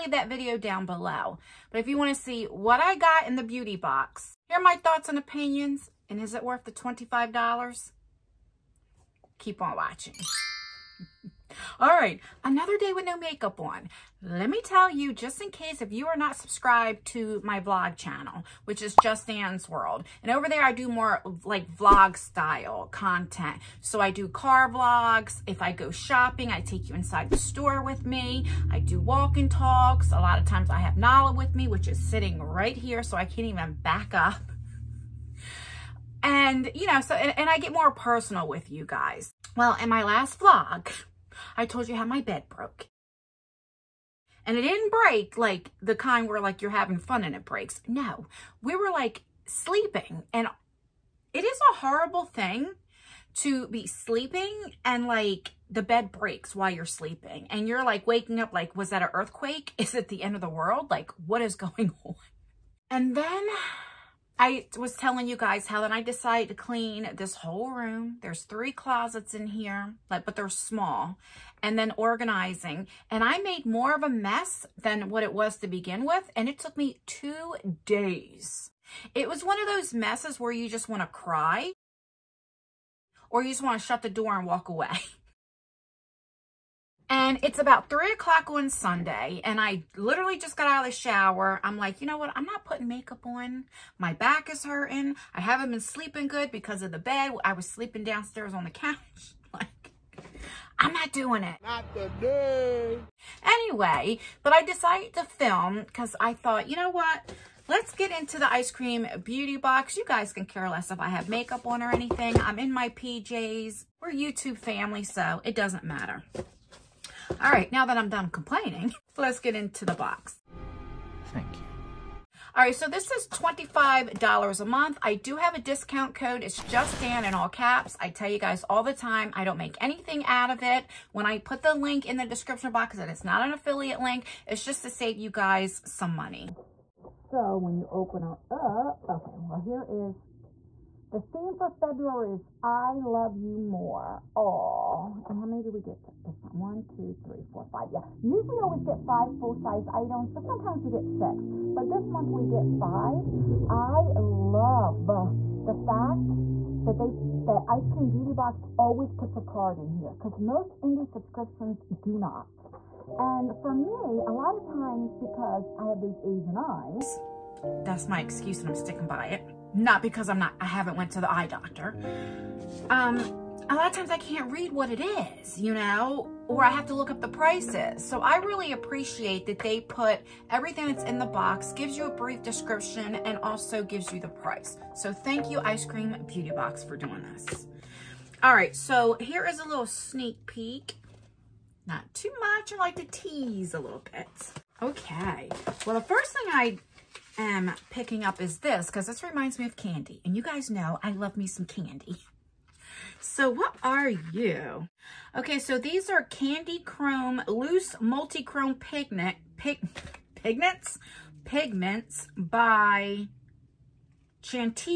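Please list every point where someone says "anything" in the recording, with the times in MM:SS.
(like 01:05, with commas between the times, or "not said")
01:51, 02:09.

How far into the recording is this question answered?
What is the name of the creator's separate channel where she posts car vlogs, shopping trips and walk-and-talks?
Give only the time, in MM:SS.
00:19.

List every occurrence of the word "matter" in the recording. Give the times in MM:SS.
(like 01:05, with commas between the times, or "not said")
01:55.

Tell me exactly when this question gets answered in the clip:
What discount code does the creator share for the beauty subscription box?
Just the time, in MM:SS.
02:06.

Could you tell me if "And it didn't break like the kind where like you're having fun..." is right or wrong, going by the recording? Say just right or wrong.
right.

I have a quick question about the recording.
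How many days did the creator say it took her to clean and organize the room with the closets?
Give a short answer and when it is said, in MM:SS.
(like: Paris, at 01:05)
2, at 01:17.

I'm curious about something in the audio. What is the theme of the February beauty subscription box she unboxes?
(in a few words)
I love you more.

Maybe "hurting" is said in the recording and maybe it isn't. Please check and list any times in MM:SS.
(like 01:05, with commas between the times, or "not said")
01:34.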